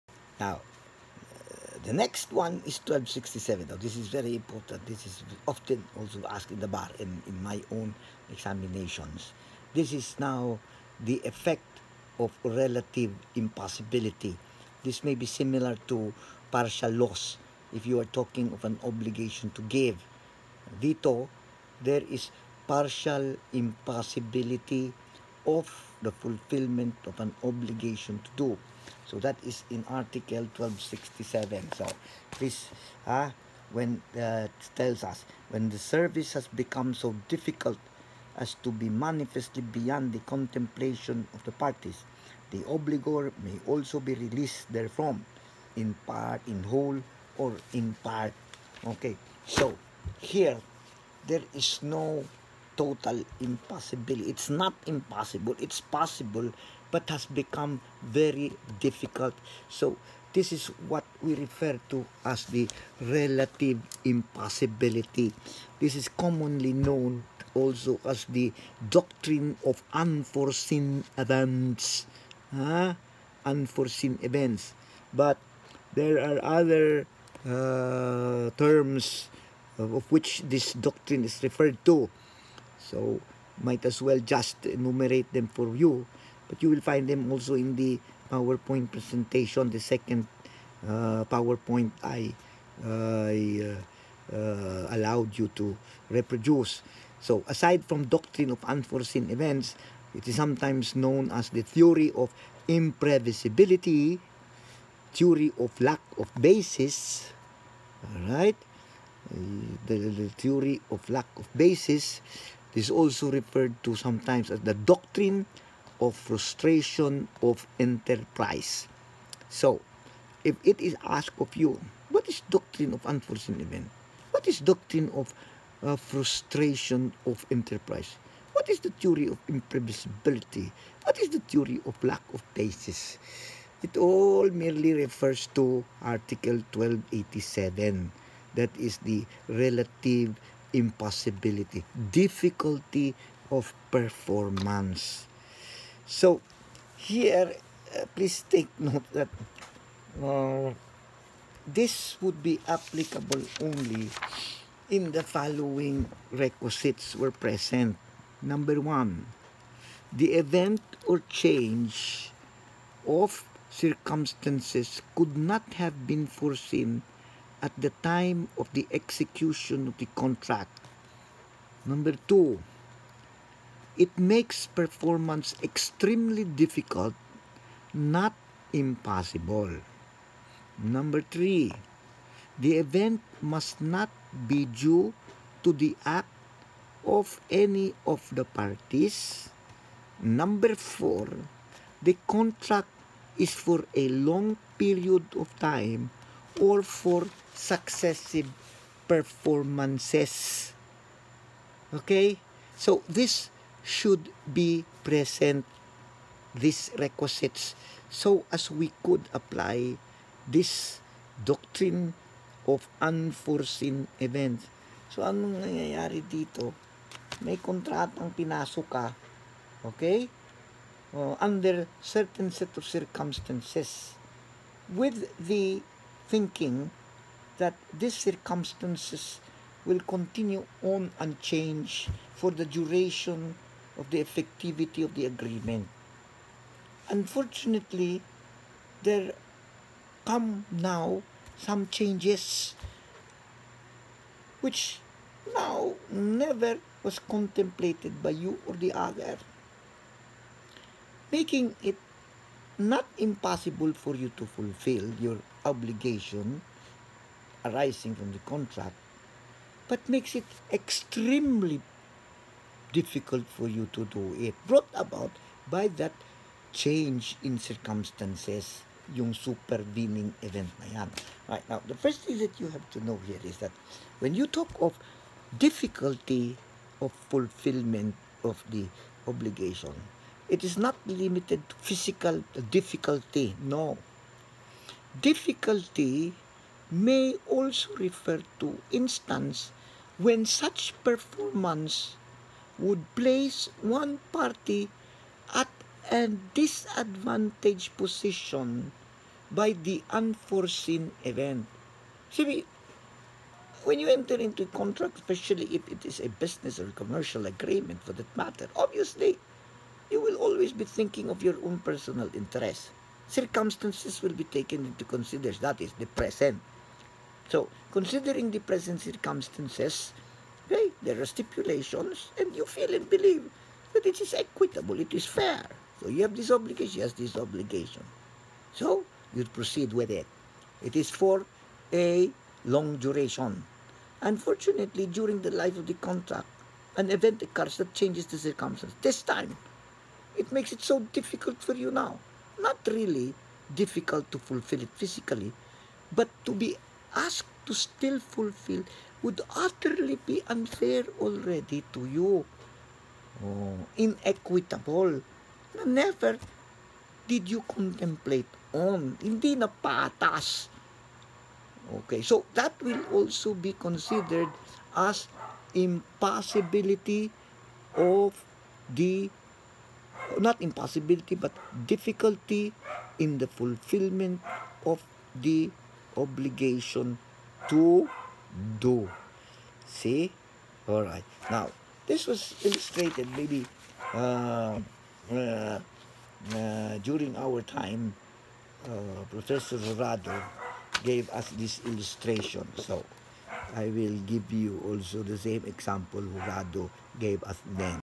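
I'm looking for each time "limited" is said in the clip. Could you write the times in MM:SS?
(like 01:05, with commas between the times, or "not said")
04:41.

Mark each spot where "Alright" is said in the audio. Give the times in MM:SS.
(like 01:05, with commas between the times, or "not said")
06:20.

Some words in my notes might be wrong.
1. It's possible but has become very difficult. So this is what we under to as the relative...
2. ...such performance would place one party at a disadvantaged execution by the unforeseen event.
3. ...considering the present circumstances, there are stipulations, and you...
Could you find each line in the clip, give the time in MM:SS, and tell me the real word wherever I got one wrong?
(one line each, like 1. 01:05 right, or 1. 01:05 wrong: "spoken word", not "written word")
1. 00:55 wrong: "refer", not "under"
2. 04:50 wrong: "position", not "execution"
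3. 05:17 right.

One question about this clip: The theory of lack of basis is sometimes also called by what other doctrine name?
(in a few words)
Doctrine of frustration of enterprise.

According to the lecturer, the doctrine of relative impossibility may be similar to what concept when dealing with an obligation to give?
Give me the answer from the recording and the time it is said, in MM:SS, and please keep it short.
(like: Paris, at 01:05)
Partial loss, at 00:16.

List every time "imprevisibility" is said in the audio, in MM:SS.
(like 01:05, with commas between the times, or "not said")
01:42, 02:09.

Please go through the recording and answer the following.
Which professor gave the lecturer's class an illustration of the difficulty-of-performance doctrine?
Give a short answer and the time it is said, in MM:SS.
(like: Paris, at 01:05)
Professor Rado, at 06:29.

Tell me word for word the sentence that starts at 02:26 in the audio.
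So here, uh, please take note that uh, this would be applicable only in the following requisites were present.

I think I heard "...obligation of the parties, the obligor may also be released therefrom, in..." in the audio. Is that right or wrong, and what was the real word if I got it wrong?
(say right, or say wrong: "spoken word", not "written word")
wrong: "contemplation", not "obligation".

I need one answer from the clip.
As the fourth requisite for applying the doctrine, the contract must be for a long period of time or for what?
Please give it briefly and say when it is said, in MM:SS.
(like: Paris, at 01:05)
Successive performances, at 03:17.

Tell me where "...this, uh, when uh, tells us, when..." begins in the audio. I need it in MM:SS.
00:32.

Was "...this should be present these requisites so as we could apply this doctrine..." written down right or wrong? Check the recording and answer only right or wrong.
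right.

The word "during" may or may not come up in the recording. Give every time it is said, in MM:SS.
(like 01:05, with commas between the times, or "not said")
05:35, 06:26.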